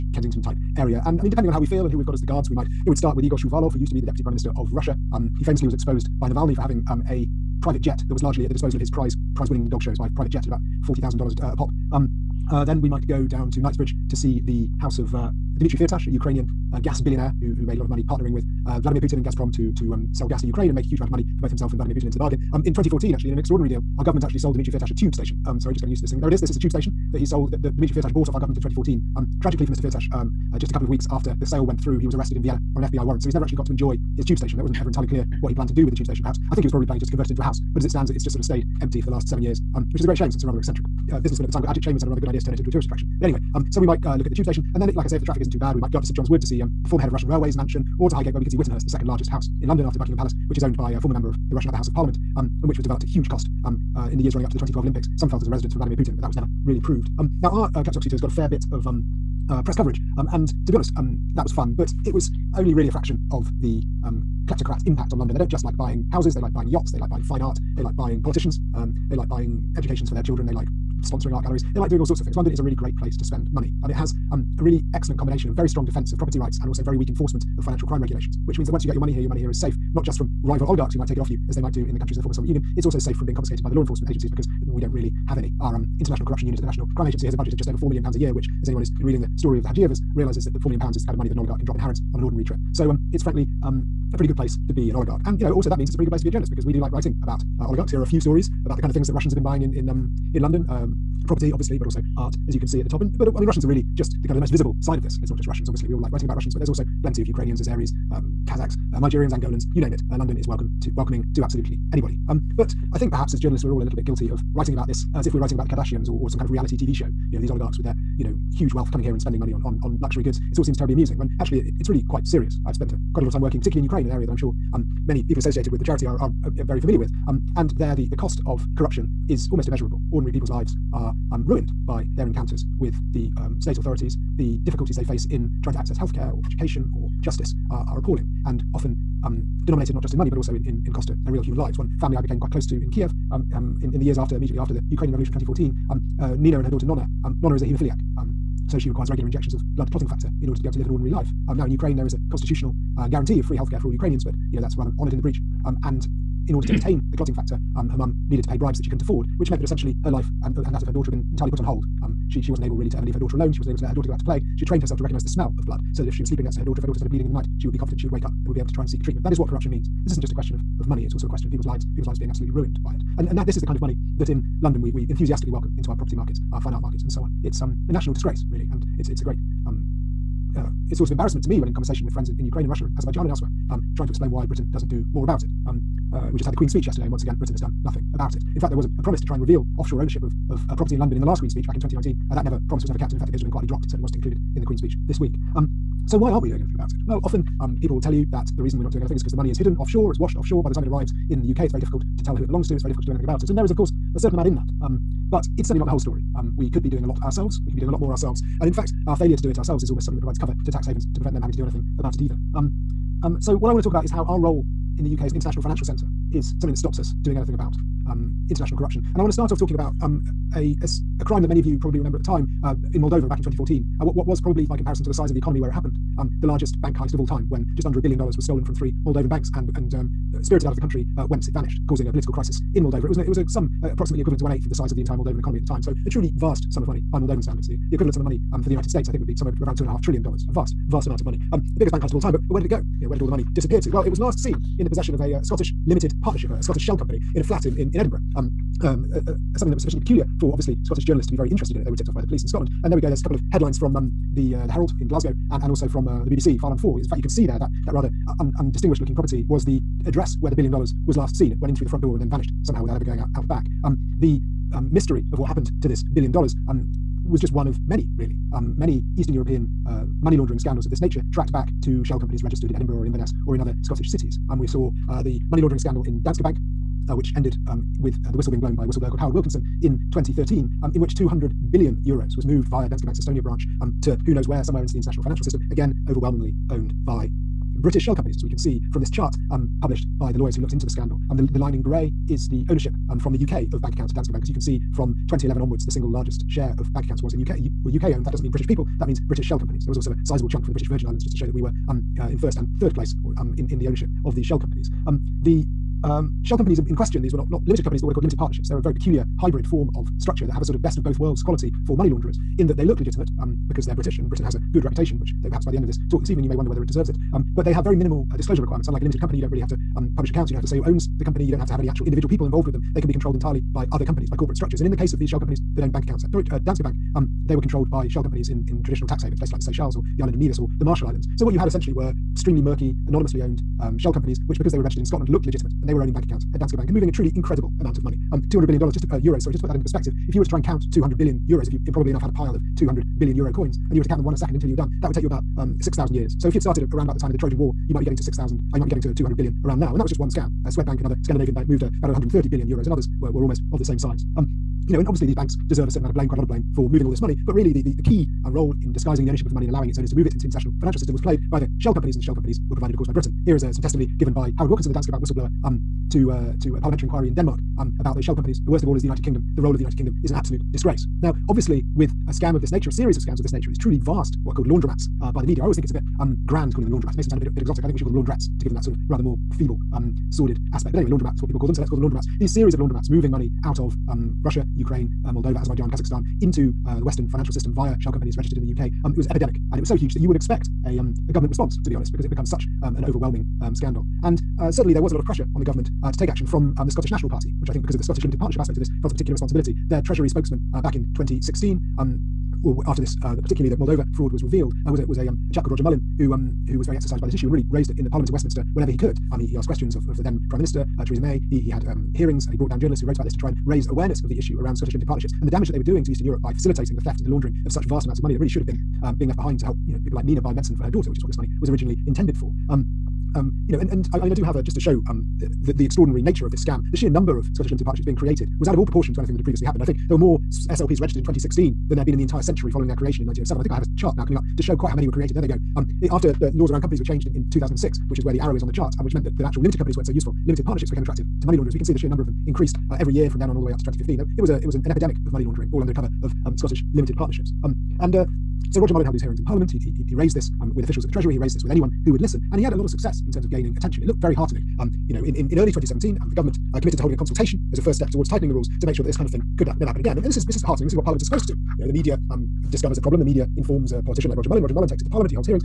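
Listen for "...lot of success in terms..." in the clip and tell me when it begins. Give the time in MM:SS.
07:32.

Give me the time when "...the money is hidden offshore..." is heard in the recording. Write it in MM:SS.
03:19.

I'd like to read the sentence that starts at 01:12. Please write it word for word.
London is a really great place to spend money.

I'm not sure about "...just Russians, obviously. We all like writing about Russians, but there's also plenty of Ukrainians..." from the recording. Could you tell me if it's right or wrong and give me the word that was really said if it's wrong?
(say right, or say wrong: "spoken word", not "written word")
right.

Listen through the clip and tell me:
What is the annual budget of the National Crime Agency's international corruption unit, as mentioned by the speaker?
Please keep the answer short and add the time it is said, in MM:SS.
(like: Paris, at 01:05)
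Just over £4 million, at 01:27.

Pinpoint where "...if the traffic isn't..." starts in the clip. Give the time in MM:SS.
00:45.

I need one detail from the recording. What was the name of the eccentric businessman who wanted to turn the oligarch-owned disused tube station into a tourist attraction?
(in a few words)
Ajit Chambers.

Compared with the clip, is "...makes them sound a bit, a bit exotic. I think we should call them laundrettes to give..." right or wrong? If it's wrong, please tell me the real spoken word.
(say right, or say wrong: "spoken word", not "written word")
right.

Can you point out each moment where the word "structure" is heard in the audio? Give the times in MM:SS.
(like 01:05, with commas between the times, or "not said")
05:10, 05:24.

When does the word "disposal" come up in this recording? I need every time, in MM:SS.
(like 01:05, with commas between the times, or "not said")
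00:08.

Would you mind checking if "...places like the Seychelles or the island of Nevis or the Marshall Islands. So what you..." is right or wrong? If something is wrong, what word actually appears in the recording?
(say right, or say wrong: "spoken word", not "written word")
right.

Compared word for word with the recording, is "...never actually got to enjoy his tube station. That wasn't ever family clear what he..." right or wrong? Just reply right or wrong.
wrong.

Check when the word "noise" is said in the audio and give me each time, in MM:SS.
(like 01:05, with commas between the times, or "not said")
not said.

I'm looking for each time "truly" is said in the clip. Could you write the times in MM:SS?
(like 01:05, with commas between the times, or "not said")
03:56, 05:37, 06:13.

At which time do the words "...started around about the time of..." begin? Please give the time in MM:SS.
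05:46.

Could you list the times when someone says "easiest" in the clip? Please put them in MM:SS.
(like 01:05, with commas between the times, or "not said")
not said.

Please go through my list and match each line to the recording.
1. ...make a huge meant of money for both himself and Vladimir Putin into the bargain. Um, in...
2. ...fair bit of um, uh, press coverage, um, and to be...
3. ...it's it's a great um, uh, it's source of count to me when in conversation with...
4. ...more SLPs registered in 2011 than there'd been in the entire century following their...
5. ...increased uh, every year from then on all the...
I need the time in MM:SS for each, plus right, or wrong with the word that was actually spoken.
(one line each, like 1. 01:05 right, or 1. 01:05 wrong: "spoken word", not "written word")
1. 00:20 wrong: "amount", not "meant"
2. 00:58 right
3. 02:58 wrong: "embarrassment", not "count"
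4. 07:10 wrong: "2016", not "2011"
5. 07:22 right.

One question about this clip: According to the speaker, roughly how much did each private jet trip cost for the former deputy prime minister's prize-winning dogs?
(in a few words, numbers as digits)
$40,000.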